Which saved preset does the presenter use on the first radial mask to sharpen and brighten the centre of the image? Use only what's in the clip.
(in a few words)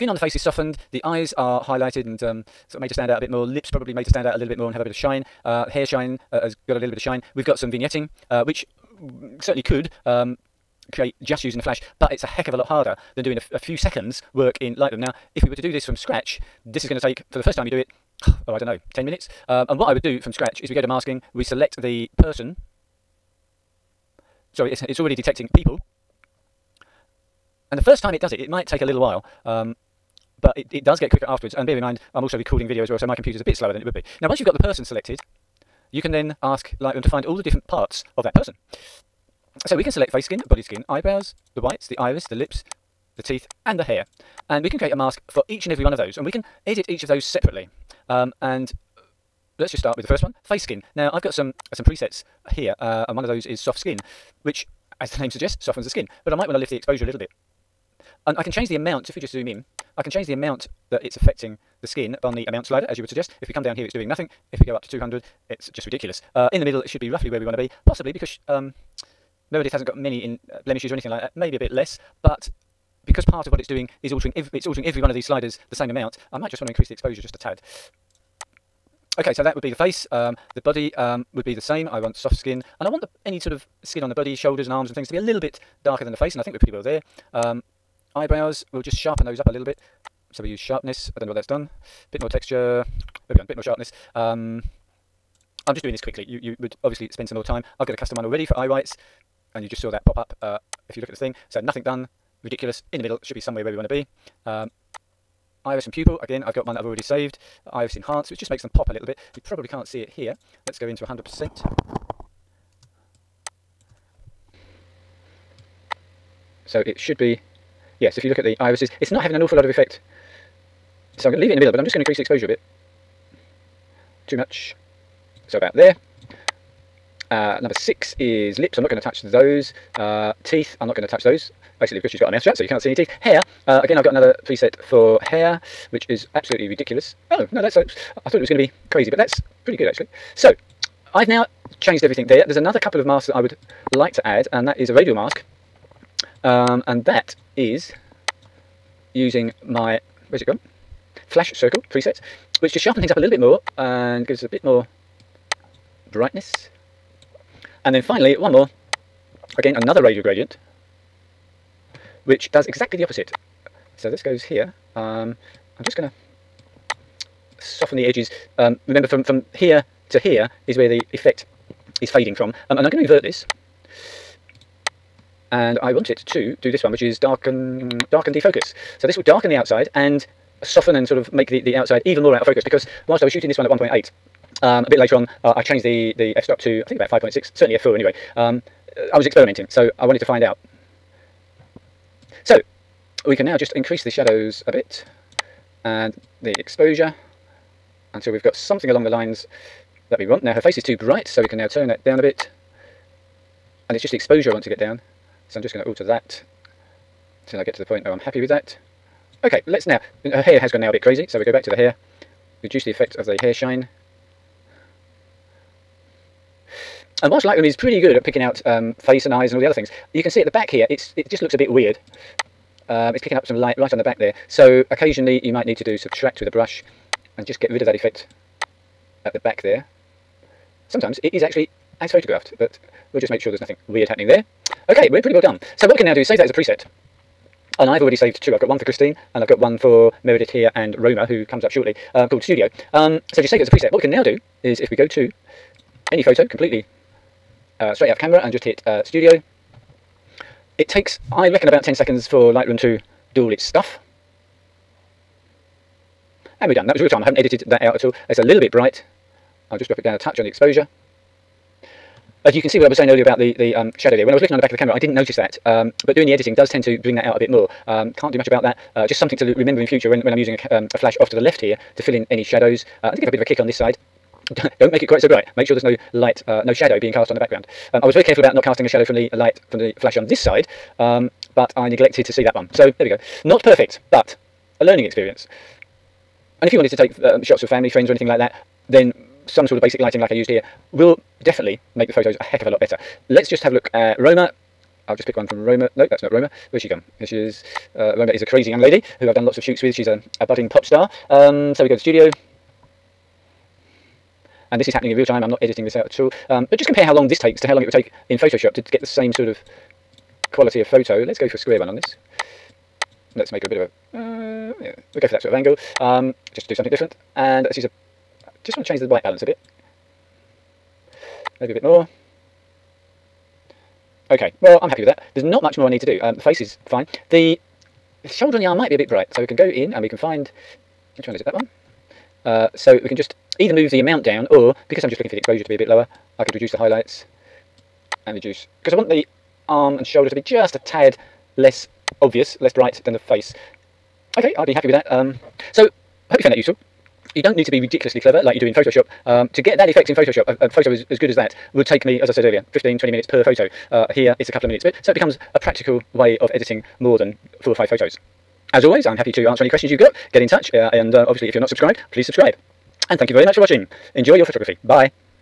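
flash circle.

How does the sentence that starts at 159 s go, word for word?
Again, another radial gradient, which does exactly the opposite.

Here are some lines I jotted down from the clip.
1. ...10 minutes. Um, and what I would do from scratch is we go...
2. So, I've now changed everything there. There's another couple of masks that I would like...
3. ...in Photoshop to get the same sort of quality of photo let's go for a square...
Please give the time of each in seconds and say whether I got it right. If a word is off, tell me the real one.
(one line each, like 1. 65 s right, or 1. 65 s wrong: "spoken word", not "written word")
1. 18 s right
2. 140 s right
3. 308 s right.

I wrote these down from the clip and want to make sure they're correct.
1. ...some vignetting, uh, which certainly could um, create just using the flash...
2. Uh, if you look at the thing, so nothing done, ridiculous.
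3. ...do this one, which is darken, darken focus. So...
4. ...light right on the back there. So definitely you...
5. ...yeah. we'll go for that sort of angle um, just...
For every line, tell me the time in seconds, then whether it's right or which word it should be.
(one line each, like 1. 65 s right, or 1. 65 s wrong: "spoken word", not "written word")
1. 7 s right
2. 100 s right
3. 176 s wrong: "defocus", not "focus"
4. 223 s wrong: "occasionally", not "definitely"
5. 314 s right.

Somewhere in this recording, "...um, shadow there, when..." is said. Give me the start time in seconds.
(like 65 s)
263 s.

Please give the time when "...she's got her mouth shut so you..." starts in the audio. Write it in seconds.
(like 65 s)
132 s.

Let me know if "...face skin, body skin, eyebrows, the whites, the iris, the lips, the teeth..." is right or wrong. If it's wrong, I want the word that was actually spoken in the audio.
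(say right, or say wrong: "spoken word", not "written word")
right.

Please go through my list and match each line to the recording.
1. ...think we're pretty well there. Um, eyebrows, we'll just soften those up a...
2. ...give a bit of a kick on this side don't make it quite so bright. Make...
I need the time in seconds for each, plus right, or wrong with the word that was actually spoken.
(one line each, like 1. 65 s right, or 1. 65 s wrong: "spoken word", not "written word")
1. 86 s wrong: "sharpen", not "soften"
2. 273 s right.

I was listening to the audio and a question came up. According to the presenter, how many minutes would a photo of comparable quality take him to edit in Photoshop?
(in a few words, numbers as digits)
15 to 20 minutes.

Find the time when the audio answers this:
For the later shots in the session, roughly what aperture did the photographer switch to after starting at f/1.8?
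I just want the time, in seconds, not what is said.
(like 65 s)
187 s.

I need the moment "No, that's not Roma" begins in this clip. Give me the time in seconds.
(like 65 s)
295 s.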